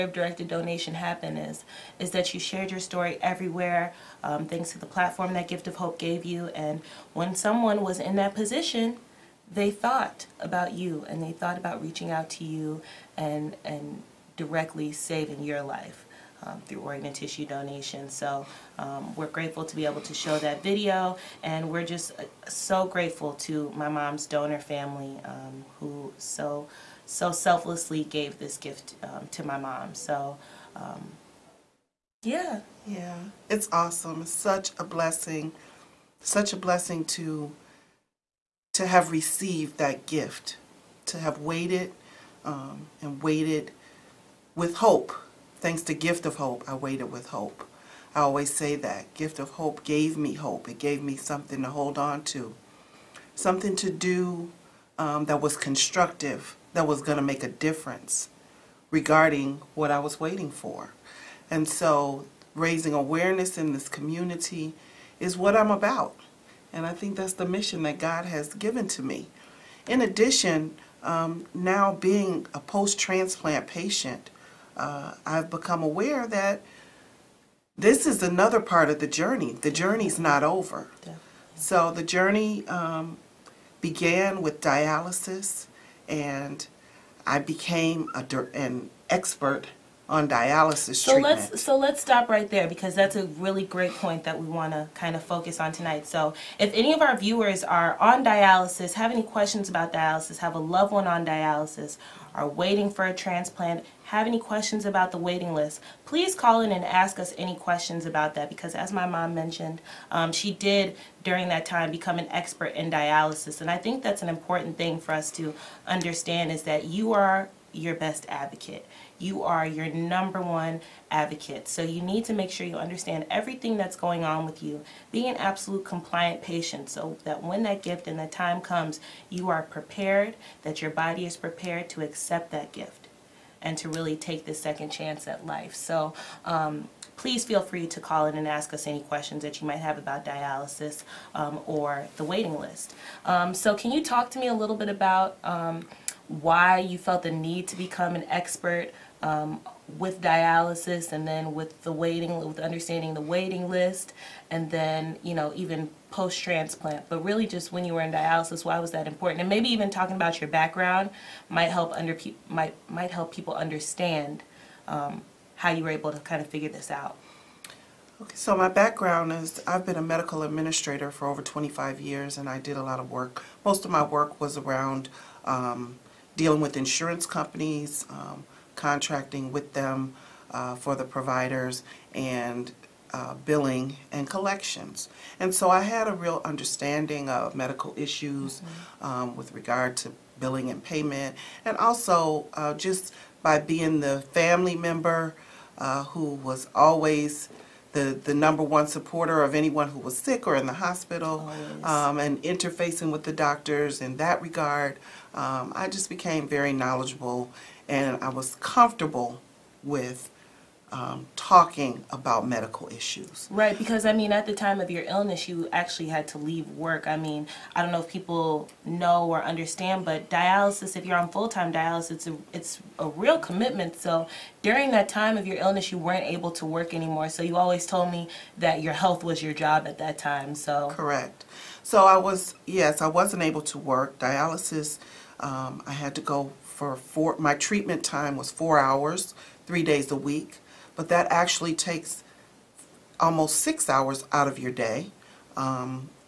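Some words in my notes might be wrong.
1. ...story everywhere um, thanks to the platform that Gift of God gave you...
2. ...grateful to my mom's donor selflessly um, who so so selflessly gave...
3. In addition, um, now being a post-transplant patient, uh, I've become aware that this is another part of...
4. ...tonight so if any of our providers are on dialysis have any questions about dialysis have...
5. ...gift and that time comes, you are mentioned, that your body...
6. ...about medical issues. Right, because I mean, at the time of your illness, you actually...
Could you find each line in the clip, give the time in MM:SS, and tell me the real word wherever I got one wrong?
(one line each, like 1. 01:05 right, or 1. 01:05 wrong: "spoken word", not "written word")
1. 00:02 wrong: "Hope", not "God"
2. 00:22 wrong: "family", not "selflessly"
3. 01:09 right
4. 01:35 wrong: "viewers", not "providers"
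5. 02:07 wrong: "prepared", not "mentioned"
6. 03:32 right.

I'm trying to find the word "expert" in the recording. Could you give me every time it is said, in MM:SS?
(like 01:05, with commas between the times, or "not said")
01:29, 01:52, 02:28.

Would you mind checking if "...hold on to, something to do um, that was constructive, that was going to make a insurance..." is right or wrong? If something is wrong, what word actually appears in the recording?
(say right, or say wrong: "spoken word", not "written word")
wrong: "difference", not "insurance".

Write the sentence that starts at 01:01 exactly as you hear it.
And so raising awareness in this community is what I'm about.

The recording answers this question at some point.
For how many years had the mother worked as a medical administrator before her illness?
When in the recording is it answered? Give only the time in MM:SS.
02:51.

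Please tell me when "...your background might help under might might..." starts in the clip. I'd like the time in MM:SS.
02:40.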